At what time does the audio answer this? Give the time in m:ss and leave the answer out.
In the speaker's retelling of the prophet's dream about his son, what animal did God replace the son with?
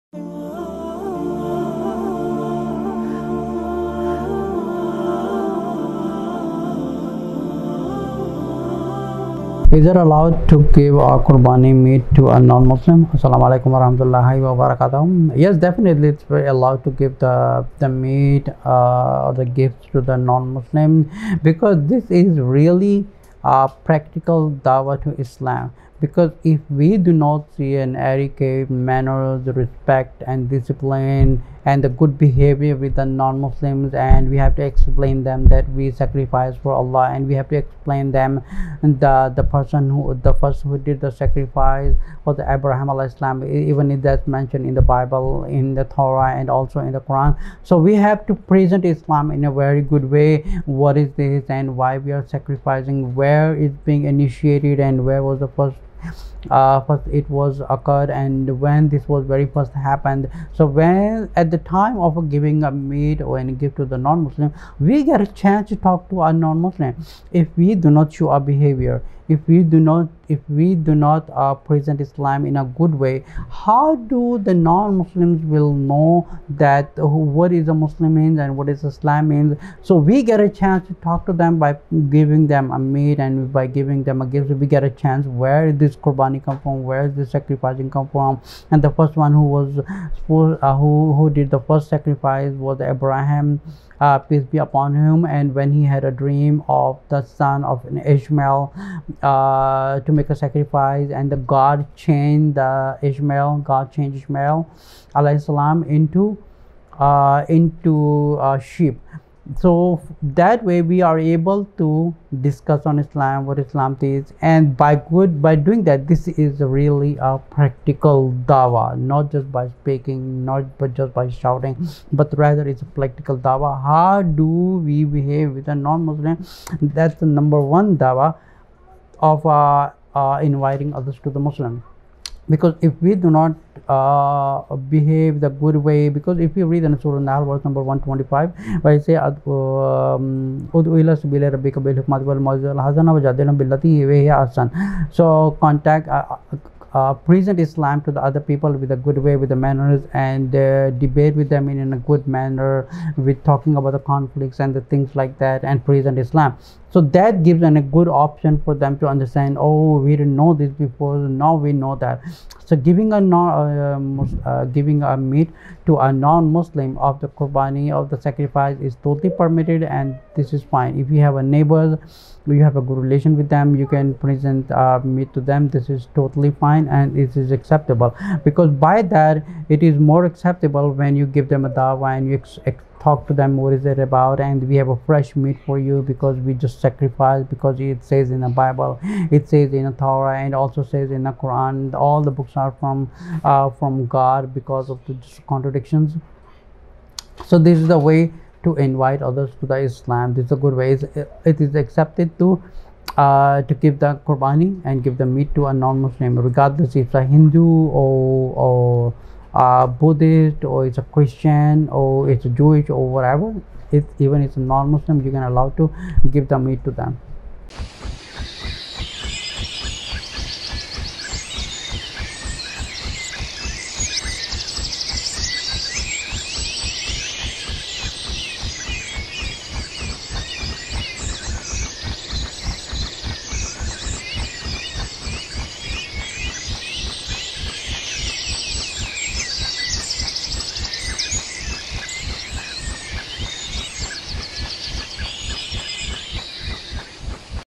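1:48.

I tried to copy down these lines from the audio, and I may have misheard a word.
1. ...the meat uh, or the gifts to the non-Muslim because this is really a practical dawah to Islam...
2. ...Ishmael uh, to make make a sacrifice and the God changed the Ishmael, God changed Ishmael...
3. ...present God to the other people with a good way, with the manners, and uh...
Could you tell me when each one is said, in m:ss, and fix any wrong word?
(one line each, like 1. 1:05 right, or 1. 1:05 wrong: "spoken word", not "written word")
1. 0:17 right
2. 1:38 right
3. 2:27 wrong: "Islam", not "God".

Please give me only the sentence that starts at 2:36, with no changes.
So that gives them a good option for them to understand.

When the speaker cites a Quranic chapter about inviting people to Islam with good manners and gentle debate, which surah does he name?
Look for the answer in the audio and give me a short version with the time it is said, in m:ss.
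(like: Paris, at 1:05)
Surah Nahl, at 2:16.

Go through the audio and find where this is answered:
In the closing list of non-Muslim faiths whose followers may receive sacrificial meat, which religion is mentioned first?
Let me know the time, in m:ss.
3:27.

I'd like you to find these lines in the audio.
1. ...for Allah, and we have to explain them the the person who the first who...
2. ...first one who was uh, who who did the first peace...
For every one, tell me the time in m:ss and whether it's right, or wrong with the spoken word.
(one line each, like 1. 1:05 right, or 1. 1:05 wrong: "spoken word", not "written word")
1. 0:36 right
2. 1:29 wrong: "sacrifice", not "peace".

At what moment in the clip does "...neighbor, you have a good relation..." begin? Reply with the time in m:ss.
2:51.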